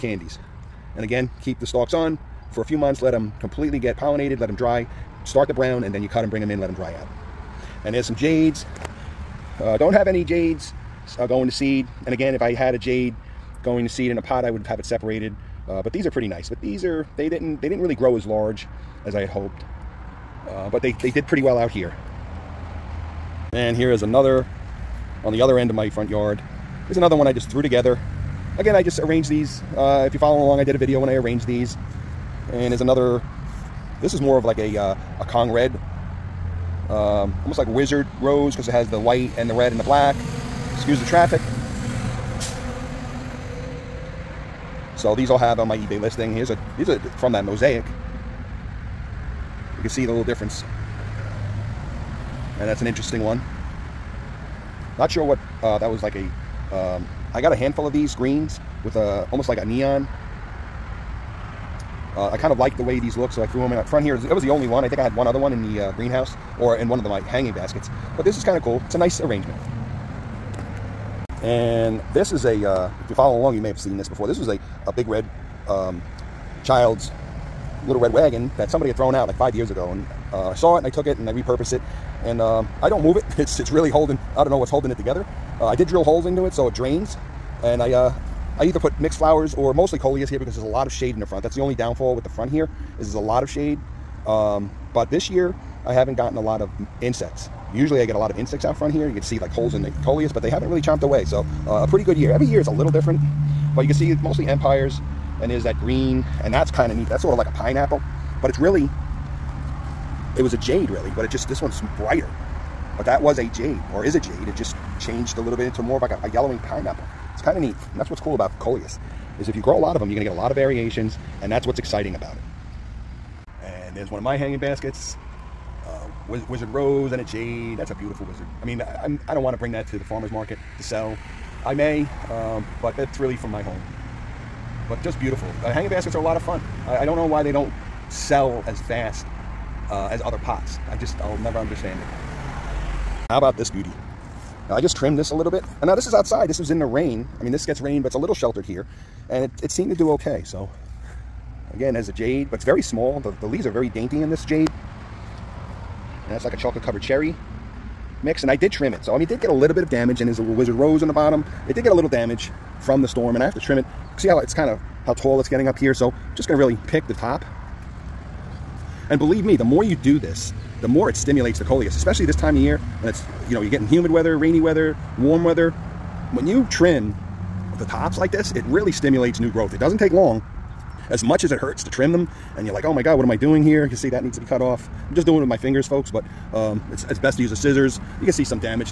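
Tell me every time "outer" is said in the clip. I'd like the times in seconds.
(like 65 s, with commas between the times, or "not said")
not said.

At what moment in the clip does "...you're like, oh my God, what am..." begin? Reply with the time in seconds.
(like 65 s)
182 s.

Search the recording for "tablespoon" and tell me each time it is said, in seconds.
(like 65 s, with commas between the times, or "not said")
not said.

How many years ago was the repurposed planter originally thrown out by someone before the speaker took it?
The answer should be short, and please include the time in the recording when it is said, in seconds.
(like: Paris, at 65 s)
5, at 79 s.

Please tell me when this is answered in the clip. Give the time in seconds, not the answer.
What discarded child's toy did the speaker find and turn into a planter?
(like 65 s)
77 s.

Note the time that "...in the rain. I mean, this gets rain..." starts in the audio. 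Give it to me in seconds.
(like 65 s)
146 s.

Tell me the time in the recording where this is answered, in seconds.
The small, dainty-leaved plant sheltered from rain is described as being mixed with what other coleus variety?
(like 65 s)
156 s.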